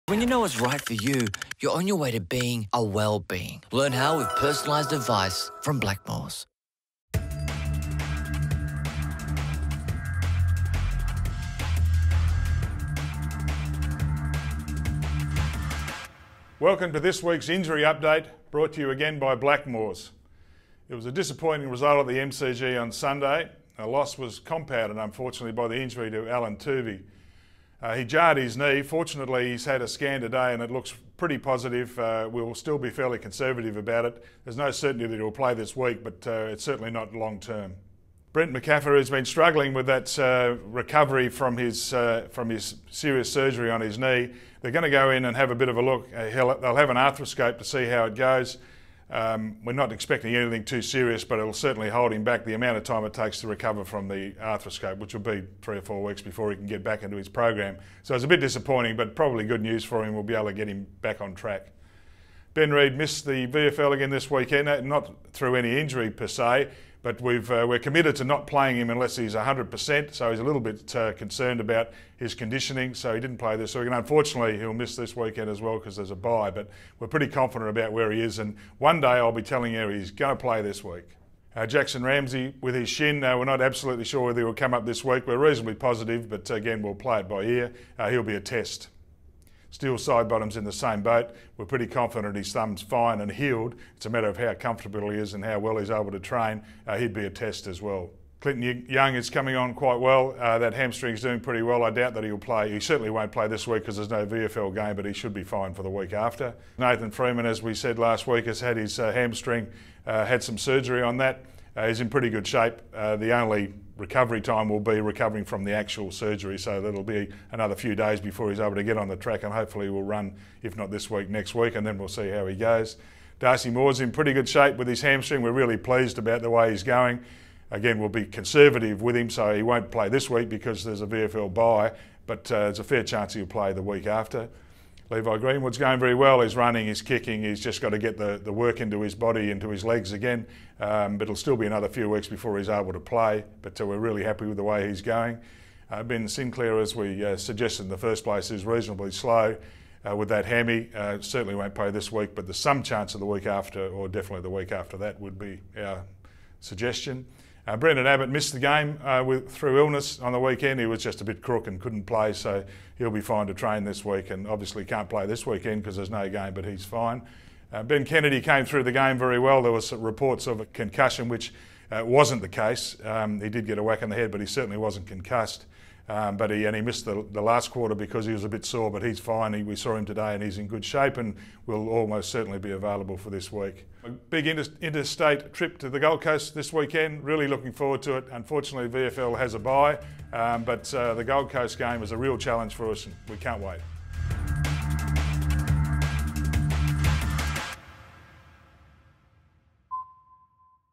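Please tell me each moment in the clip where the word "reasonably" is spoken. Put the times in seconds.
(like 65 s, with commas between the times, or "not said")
85 s, 148 s.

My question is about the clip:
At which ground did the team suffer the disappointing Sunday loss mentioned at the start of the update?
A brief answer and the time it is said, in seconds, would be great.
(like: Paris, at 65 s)
MCG, at 22 s.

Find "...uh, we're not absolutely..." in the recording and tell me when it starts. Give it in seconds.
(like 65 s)
83 s.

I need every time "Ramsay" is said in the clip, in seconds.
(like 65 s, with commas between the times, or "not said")
82 s.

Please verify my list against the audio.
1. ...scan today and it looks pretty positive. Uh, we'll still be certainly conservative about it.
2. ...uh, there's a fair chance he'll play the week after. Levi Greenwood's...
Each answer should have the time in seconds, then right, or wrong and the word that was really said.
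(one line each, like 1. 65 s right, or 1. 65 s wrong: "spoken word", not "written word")
1. 29 s wrong: "fairly", not "certainly"
2. 132 s right.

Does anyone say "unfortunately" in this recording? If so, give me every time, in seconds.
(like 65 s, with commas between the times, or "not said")
24 s, 73 s, 188 s.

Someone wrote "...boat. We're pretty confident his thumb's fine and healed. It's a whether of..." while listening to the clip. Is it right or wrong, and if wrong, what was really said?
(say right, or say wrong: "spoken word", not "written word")
wrong: "matter", not "whether".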